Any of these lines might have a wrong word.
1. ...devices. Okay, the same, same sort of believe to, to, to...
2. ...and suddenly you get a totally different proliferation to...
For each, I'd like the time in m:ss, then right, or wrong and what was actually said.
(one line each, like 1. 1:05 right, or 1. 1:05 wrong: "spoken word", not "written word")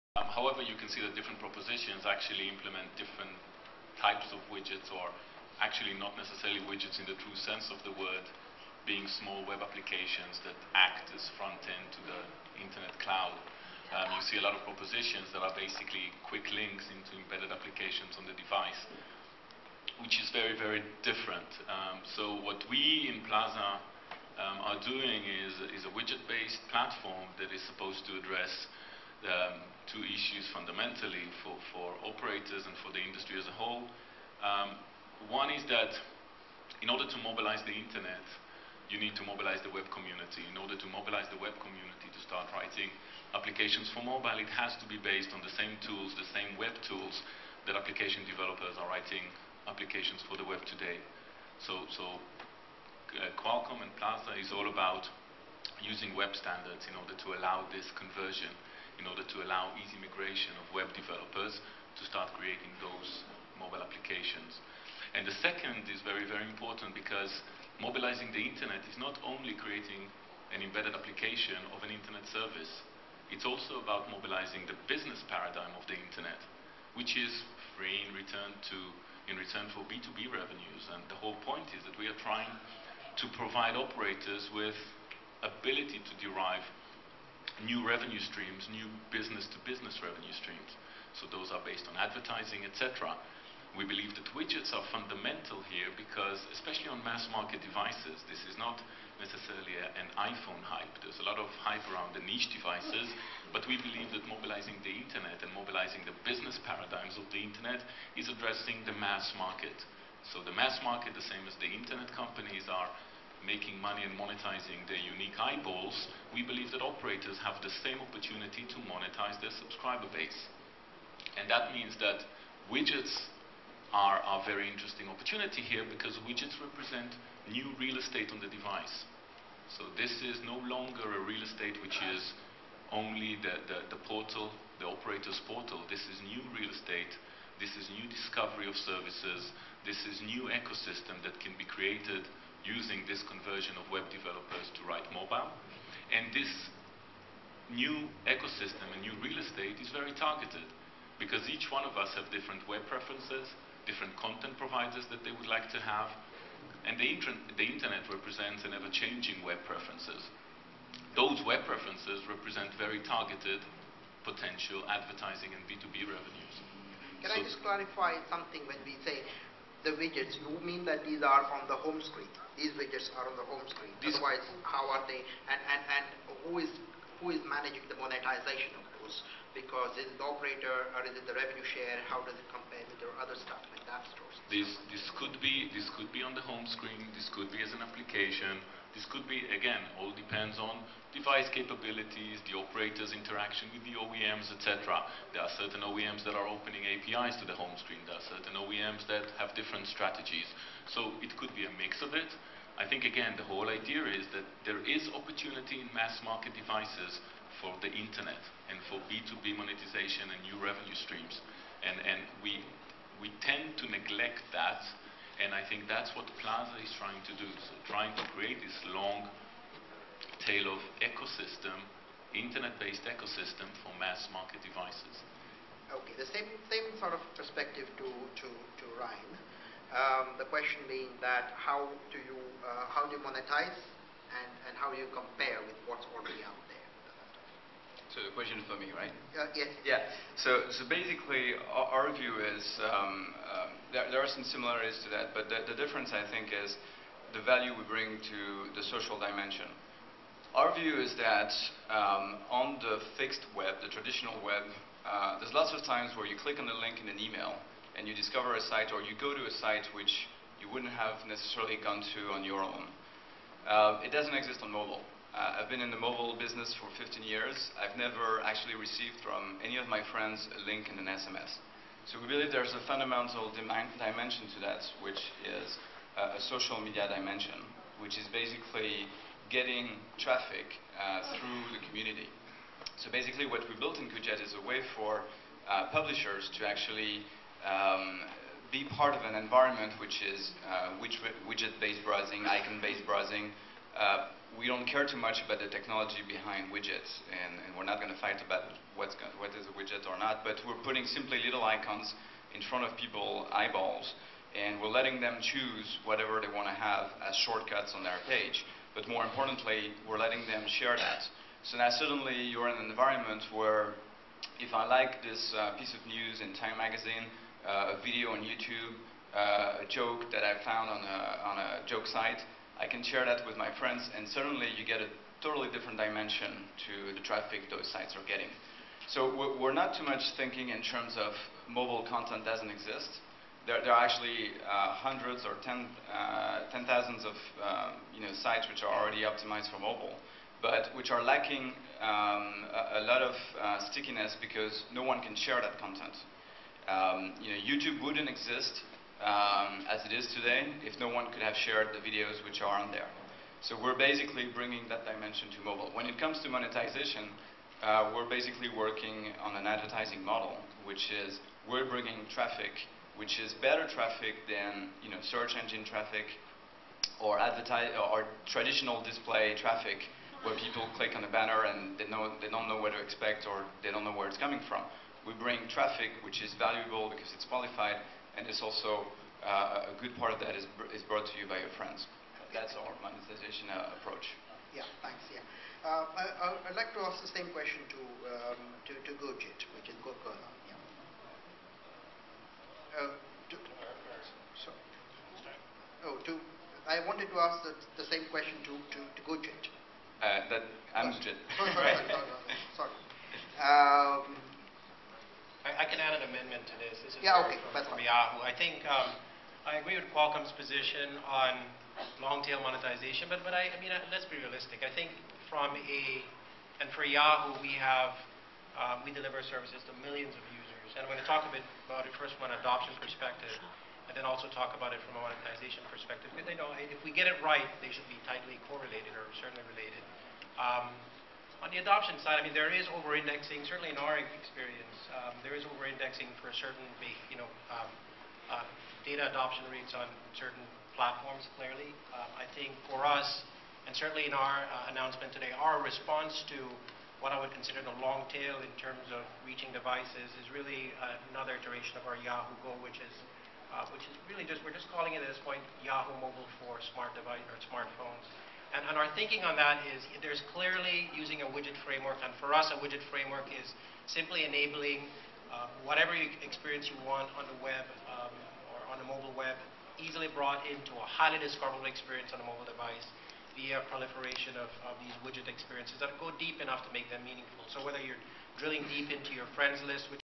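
1. 3:44 wrong: "perspective", not "believe"
2. 5:24 wrong: "dimension", not "proliferation".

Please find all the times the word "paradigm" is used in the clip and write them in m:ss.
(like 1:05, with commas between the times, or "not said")
1:15, 1:46.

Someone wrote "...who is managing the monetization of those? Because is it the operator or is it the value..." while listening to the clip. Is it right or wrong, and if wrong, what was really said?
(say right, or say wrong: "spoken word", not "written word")
wrong: "revenue", not "value".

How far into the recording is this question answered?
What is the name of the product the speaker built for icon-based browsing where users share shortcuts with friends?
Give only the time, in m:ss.
4:44.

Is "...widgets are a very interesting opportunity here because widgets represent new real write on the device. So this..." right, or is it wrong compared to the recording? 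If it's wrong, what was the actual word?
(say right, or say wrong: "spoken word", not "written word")
wrong: "estate", not "write".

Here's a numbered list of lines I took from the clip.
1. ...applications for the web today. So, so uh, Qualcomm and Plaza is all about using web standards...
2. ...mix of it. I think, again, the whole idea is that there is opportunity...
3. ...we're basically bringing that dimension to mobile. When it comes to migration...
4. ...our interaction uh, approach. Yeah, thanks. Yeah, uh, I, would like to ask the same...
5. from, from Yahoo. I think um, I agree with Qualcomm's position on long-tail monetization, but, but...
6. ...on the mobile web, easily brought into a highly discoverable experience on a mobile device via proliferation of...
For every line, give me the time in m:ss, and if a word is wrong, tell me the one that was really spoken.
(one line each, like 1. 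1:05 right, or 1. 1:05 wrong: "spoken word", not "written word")
1. 0:49 right
2. 3:21 right
3. 5:53 wrong: "monetization", not "migration"
4. 6:22 wrong: "monetization", not "interaction"
5. 6:47 right
6. 7:48 right.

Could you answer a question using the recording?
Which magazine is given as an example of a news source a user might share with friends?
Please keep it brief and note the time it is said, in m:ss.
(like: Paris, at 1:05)
Time Magazine, at 5:16.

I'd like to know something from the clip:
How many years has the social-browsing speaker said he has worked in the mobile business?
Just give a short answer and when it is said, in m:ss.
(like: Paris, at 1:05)
15, at 4:27.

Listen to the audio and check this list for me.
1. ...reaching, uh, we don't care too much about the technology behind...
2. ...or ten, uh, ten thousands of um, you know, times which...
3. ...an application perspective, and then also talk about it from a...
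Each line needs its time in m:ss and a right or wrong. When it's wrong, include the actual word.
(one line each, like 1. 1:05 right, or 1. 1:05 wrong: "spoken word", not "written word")
1. 4:53 wrong: "browsing", not "reaching"
2. 5:35 wrong: "sites", not "times"
3. 7:02 wrong: "adoption", not "application".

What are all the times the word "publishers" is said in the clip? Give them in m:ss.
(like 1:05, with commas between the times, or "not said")
4:45.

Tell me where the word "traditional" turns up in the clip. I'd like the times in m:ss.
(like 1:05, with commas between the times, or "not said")
4:13, 6:08.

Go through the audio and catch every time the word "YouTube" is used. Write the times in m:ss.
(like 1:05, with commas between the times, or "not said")
5:18, 5:47.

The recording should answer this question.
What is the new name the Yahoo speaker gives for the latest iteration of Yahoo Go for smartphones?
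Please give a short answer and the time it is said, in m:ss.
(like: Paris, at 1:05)
Yahoo Mobile, at 7:35.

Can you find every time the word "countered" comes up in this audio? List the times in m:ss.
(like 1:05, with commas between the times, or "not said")
not said.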